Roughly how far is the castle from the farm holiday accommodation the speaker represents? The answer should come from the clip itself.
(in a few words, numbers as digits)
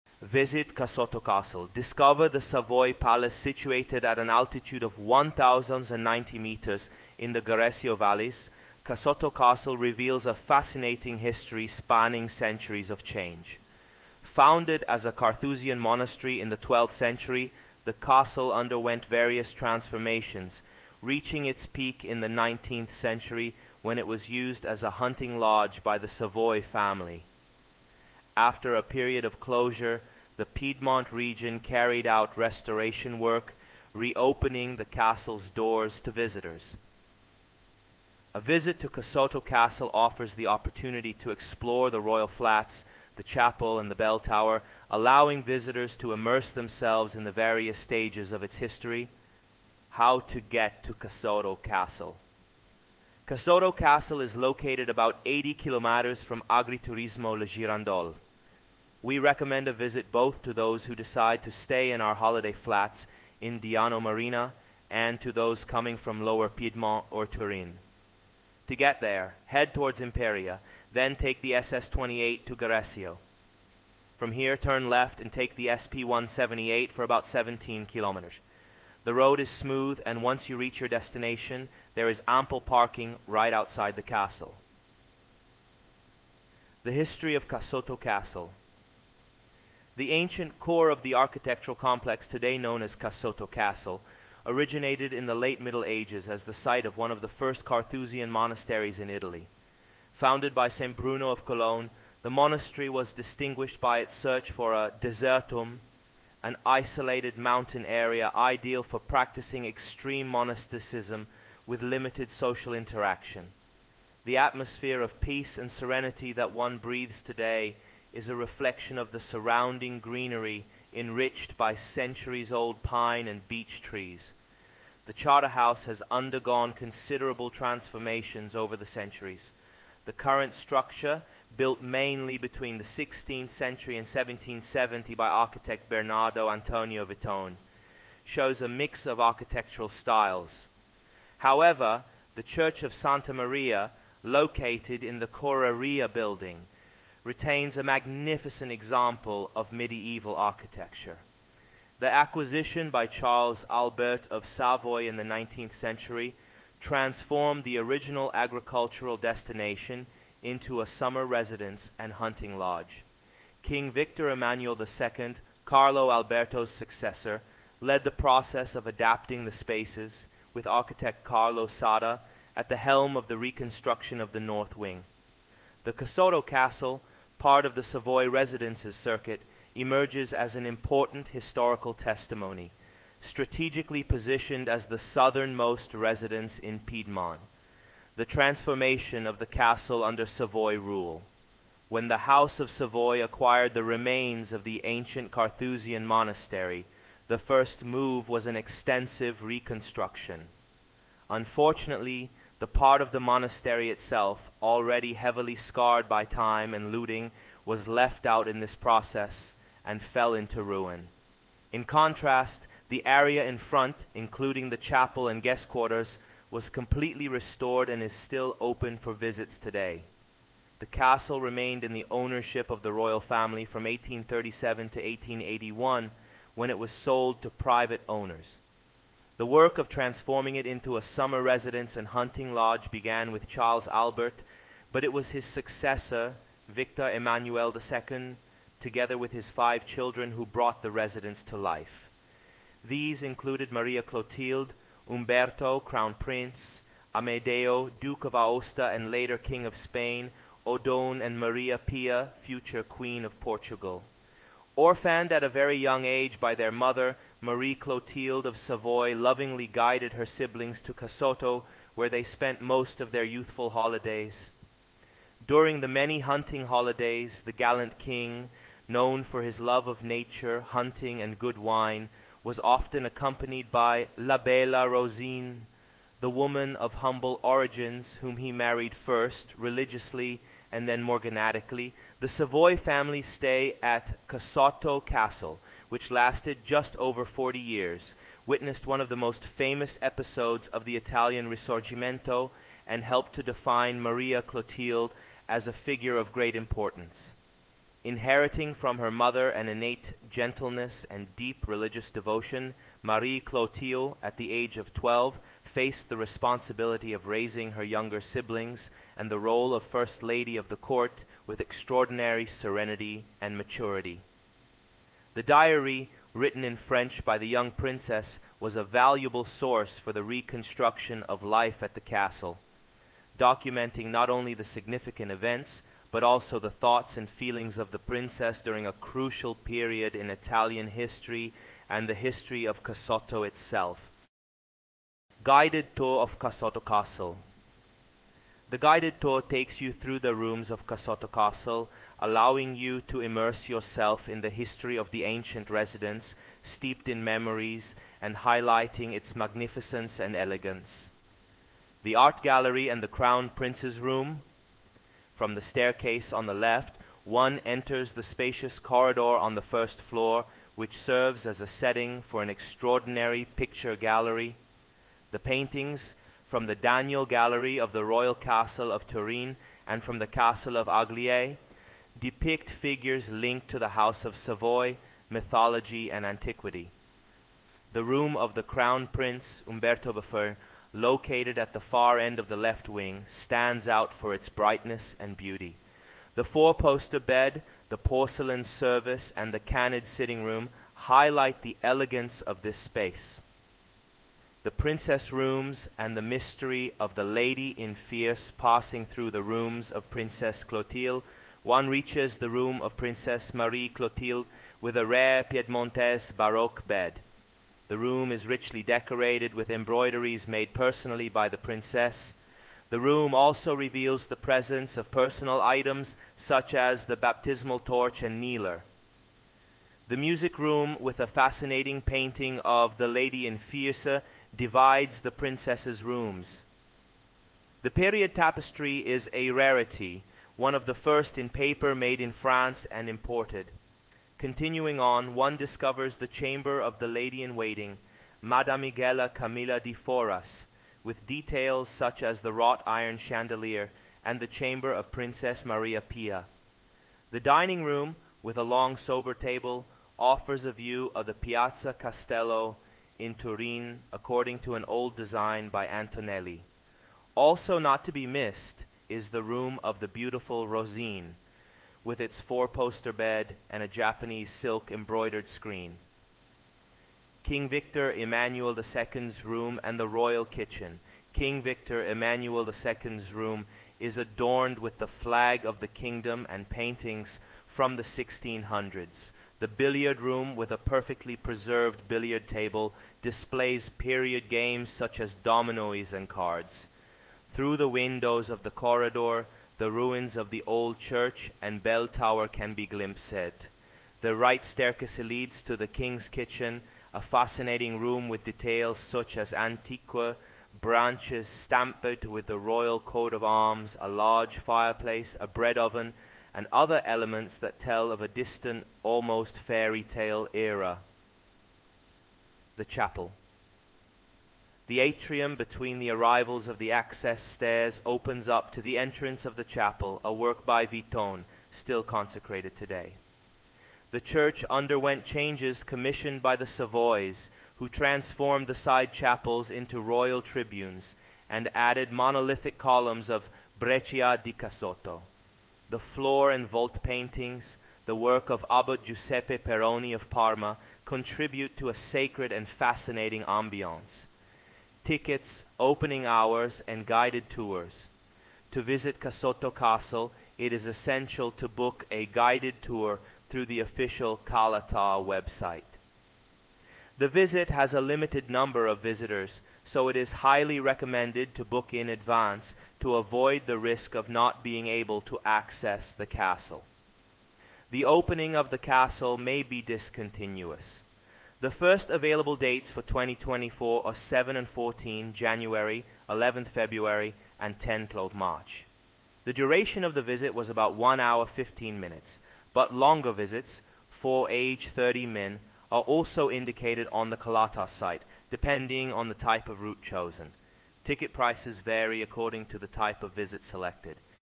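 80 kilometers.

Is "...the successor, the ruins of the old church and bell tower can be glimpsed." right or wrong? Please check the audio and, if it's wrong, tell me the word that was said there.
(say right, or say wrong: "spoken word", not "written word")
wrong: "corridor", not "successor".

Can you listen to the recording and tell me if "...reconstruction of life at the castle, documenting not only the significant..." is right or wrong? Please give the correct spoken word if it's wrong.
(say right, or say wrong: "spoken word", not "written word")
right.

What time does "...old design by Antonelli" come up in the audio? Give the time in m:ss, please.
7:34.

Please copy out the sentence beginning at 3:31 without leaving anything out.
In contrast, the area in front, including the chapel and guest quarters, was completely restored and is still open for visits today.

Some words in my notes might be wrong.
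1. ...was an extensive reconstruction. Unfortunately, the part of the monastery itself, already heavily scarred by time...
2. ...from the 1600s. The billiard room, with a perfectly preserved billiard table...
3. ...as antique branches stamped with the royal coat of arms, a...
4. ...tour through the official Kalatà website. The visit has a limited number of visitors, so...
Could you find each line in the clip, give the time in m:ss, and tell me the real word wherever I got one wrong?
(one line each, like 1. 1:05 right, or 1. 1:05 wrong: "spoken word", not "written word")
1. 3:18 right
2. 7:57 right
3. 8:19 right
4. 9:12 right.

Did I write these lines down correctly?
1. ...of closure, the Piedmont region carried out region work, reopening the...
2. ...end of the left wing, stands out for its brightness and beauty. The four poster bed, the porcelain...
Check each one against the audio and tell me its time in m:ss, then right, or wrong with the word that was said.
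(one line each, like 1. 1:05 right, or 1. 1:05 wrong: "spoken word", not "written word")
1. 0:29 wrong: "restoration", not "region"
2. 6:22 right.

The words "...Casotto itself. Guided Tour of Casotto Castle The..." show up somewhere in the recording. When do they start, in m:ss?
5:32.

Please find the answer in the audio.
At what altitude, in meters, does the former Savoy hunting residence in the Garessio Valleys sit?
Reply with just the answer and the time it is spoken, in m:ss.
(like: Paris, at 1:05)
1,090 meters, at 0:04.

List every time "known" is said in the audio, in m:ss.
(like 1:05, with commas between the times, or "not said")
1:32, 4:28.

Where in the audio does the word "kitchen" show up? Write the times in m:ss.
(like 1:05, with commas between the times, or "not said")
7:50, 8:16.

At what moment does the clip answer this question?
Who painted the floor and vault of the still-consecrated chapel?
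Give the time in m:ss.
8:59.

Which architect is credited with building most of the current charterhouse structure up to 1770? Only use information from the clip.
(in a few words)
Bernardo Antonio Vittone.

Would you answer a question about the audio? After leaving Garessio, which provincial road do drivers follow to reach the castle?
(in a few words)
SP 178.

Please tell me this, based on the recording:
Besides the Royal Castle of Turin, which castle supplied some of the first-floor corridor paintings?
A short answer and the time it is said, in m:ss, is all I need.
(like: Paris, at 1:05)
Castle of Agliè, at 6:10.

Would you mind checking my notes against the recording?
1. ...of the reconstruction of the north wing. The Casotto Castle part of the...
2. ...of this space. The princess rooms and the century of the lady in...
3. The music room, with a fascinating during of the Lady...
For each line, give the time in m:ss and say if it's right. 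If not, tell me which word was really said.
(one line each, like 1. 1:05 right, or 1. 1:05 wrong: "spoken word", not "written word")
1. 2:53 right
2. 6:32 wrong: "mystery", not "century"
3. 7:00 wrong: "painting", not "during".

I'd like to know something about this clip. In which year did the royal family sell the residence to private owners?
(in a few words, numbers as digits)
1881.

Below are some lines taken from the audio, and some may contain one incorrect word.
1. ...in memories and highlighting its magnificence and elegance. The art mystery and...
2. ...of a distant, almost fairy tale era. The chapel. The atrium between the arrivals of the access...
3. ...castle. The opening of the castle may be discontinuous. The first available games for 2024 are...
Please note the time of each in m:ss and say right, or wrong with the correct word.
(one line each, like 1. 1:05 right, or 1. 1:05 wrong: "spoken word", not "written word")
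1. 5:47 wrong: "gallery", not "mystery"
2. 8:28 right
3. 9:26 wrong: "dates", not "games".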